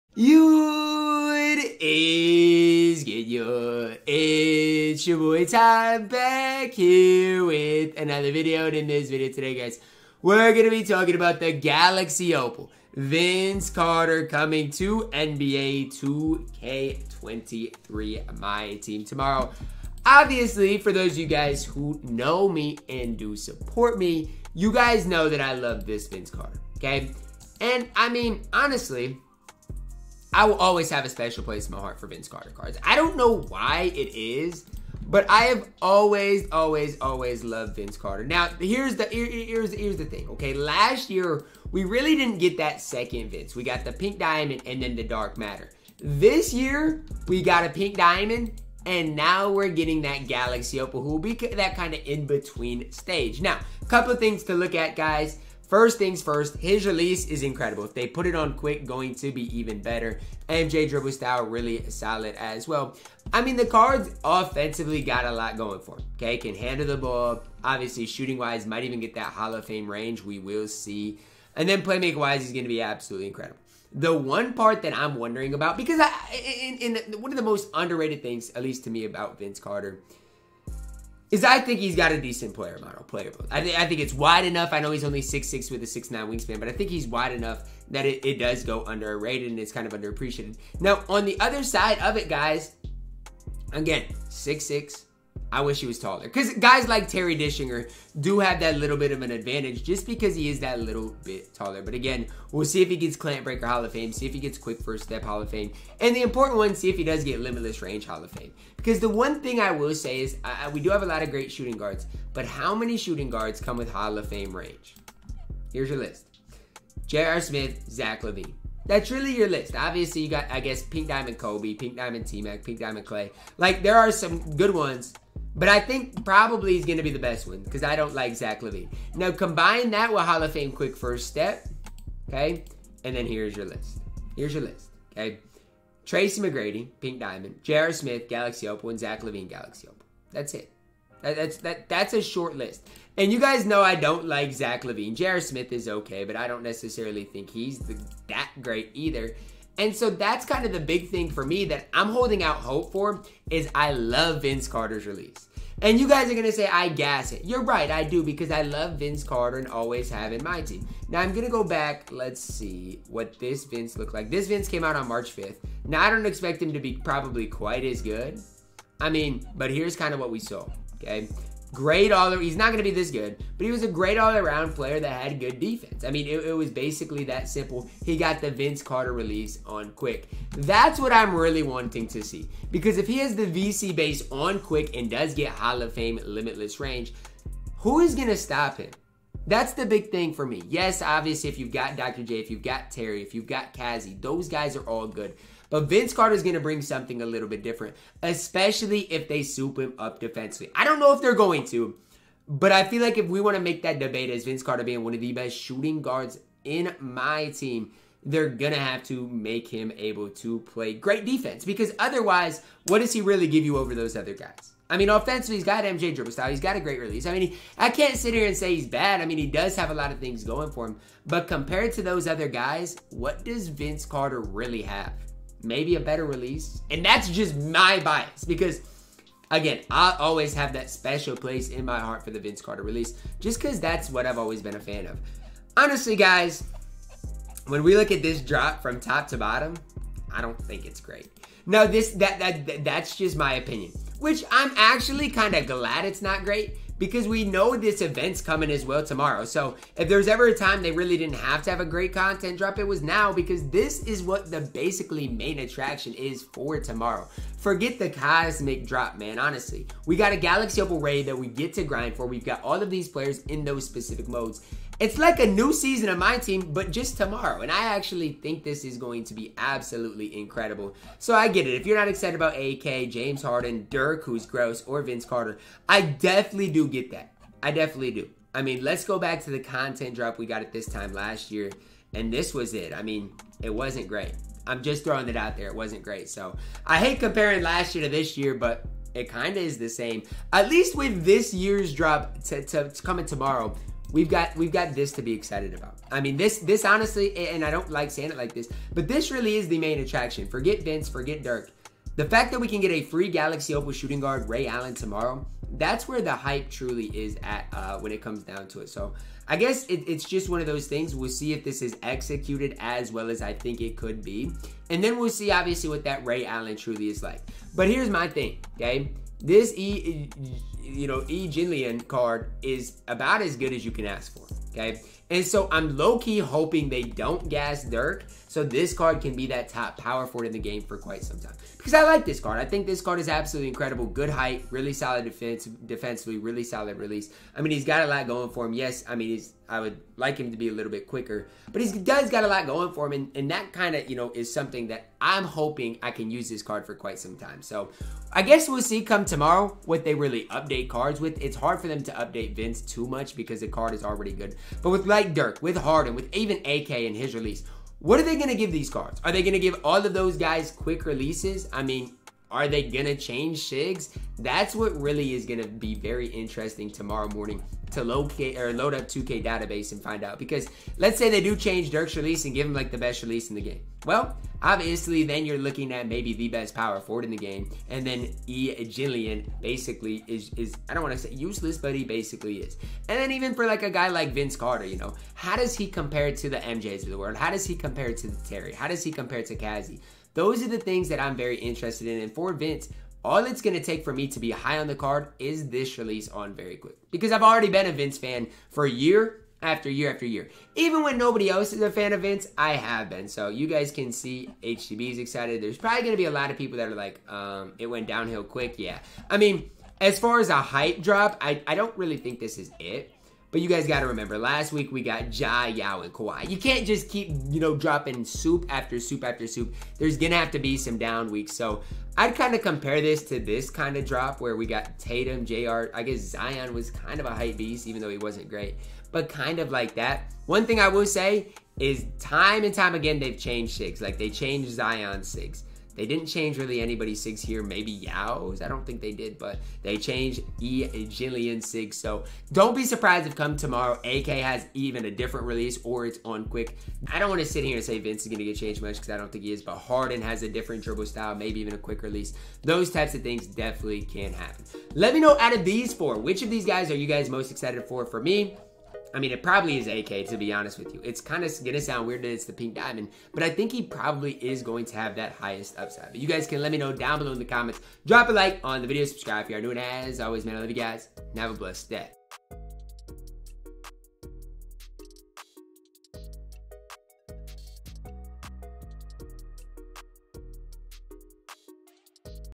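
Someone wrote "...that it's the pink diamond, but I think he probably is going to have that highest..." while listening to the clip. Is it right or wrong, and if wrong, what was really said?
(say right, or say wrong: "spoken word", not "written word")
right.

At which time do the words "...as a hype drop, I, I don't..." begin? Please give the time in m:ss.
6:50.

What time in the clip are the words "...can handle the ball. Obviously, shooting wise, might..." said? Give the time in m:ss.
1:06.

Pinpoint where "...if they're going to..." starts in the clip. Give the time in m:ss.
3:21.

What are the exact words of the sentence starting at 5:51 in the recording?
It's hard for them to update Vince too much because the card is already good.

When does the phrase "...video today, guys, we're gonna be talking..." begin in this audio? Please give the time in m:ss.
0:09.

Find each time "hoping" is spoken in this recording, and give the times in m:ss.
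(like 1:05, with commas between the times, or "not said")
5:26, 5:45.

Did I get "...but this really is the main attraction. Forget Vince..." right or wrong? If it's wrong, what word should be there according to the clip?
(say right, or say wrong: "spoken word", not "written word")
right.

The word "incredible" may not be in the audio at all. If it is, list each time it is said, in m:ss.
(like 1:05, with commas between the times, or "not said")
0:57, 1:13, 4:30, 5:33.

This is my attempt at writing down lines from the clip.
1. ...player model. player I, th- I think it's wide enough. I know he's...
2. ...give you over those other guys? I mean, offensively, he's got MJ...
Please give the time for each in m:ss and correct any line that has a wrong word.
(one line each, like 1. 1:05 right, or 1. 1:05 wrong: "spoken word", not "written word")
1. 1:22 right
2. 3:33 right.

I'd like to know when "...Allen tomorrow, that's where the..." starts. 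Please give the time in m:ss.
5:04.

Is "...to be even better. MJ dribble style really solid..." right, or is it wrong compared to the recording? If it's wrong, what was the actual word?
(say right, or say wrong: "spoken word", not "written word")
right.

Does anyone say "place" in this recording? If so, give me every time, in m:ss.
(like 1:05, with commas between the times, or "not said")
0:31, 3:51.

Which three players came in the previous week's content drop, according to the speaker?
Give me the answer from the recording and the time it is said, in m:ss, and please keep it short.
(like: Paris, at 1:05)
Ja, Yao, and Kawhi, at 6:55.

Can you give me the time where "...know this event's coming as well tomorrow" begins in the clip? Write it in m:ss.
4:07.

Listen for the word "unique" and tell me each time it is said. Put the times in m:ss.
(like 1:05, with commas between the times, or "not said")
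not said.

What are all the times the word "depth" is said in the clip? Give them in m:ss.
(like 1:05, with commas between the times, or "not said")
not said.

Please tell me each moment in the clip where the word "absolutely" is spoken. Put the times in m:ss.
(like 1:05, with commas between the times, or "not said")
1:12, 4:29, 5:33.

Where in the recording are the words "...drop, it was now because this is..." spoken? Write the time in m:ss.
4:12.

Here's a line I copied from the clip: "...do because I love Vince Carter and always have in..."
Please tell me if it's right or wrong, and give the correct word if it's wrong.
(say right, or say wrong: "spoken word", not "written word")
right.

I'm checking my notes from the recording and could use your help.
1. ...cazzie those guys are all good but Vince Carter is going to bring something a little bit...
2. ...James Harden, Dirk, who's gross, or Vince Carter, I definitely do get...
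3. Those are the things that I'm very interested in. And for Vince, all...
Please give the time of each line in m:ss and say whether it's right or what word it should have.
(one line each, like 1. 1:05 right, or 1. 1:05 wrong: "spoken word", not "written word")
1. 3:13 right
2. 4:33 right
3. 6:30 right.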